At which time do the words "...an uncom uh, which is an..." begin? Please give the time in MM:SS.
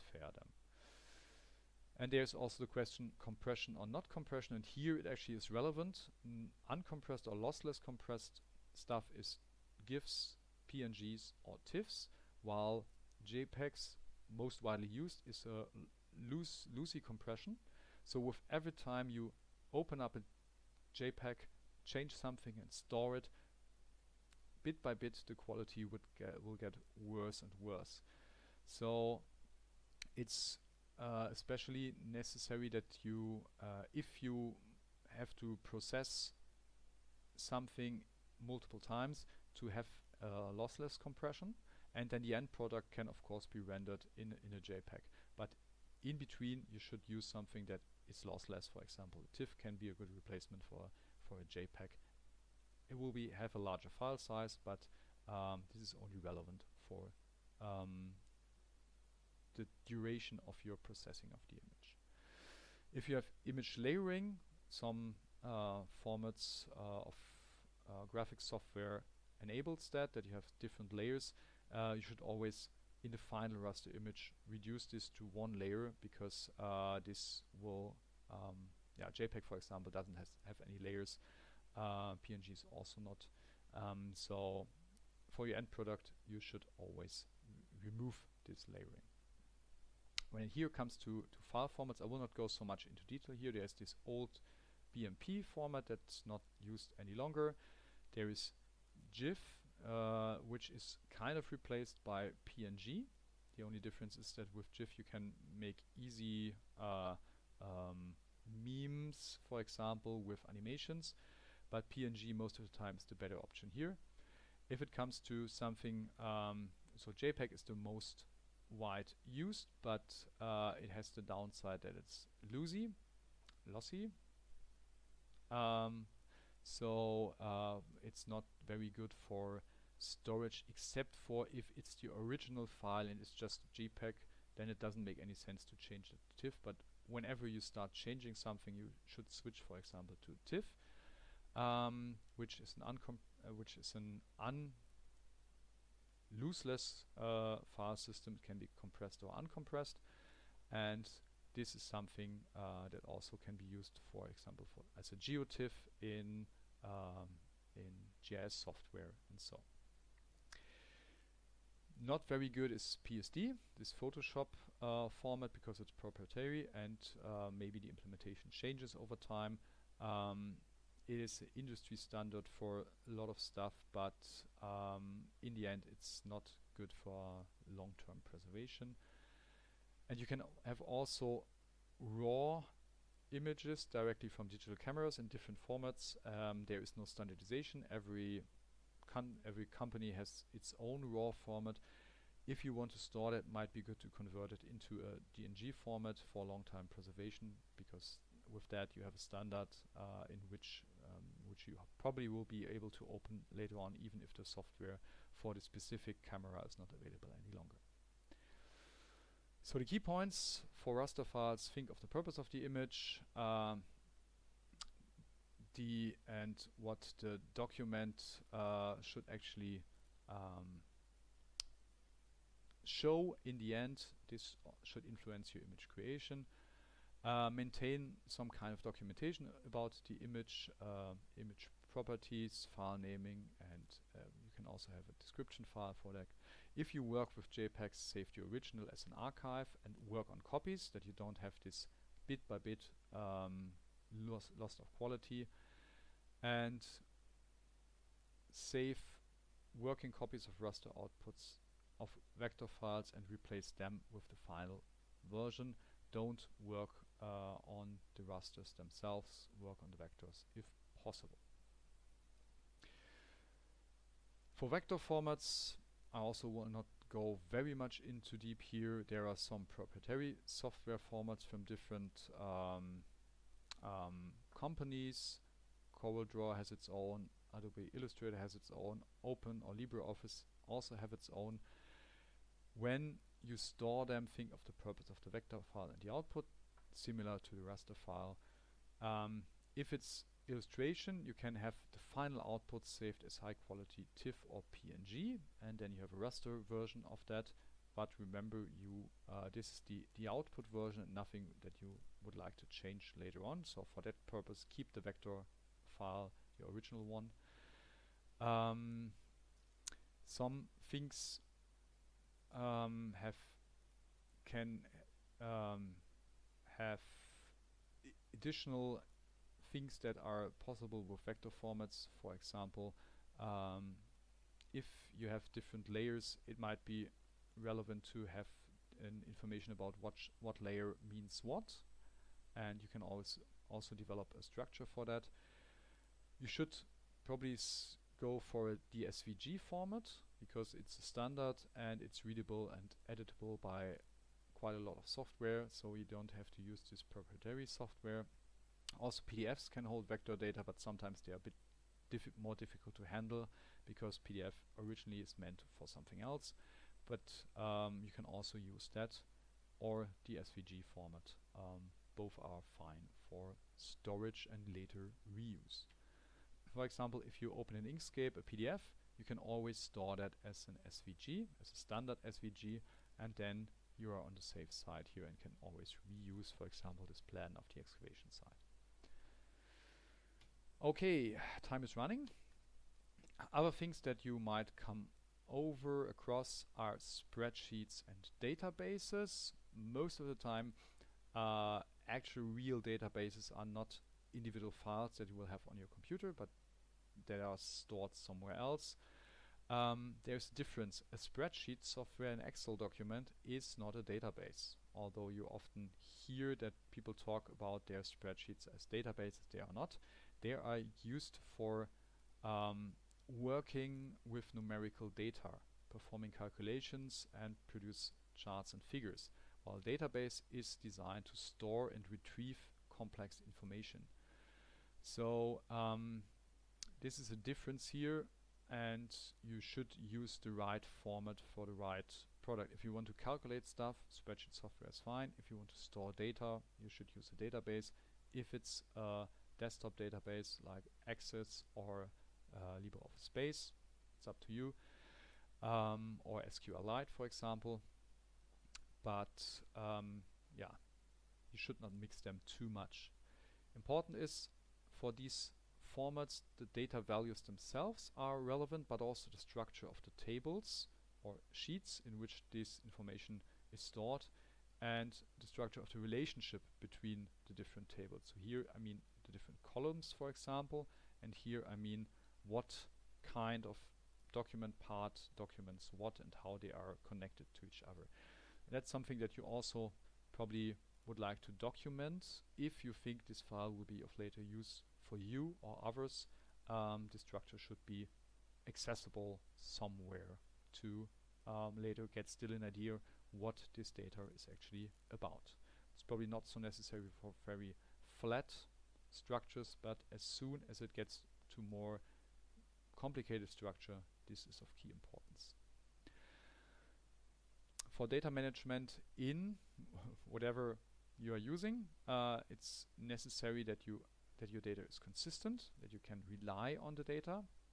02:22.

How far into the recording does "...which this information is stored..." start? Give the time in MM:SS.
07:42.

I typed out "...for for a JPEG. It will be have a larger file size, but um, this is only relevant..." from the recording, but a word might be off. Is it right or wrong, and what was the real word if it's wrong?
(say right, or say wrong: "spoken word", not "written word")
right.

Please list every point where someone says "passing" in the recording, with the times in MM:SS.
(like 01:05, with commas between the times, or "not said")
not said.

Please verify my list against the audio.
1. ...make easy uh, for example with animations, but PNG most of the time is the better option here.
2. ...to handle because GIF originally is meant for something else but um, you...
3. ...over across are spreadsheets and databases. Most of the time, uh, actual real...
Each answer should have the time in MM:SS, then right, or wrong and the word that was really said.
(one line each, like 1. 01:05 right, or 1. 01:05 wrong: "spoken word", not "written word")
1. 01:45 right
2. 05:52 wrong: "PDF", not "GIF"
3. 06:25 right.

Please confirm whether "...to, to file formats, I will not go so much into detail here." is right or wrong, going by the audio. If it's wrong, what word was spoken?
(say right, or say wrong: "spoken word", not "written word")
right.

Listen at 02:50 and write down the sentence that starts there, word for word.
Um, it is industry standard for a lot of stuff, but um, in the end it's not good for long-term preservation.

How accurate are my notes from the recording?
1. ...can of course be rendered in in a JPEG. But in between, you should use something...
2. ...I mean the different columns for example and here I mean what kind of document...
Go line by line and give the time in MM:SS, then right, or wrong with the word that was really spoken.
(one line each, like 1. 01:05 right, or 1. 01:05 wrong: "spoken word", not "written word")
1. 00:42 right
2. 07:48 right.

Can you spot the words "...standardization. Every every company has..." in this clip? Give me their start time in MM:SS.
03:07.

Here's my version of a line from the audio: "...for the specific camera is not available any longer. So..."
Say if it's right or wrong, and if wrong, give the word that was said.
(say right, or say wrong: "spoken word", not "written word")
right.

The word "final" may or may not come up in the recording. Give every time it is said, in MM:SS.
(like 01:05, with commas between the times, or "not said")
01:13, 04:14, 04:52.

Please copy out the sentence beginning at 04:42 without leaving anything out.
When you store them, think of the purpose of the vector file and the output, similar to the raster file.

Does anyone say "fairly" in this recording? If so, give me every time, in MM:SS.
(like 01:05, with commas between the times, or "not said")
not said.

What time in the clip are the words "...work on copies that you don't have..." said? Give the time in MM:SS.
04:00.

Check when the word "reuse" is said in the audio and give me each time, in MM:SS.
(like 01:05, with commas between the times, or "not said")
06:05, 06:16.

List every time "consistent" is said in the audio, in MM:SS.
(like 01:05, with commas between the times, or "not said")
08:34.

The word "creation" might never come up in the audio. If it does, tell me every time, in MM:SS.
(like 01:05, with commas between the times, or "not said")
03:45.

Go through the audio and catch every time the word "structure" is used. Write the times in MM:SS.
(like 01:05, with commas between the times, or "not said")
05:34, 07:39, 07:45, 08:07, 08:19, 08:23.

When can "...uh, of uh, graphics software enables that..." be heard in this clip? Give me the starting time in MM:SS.
01:06.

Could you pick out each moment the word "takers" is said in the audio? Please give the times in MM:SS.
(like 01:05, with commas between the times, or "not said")
not said.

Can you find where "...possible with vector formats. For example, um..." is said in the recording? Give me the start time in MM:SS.
05:20.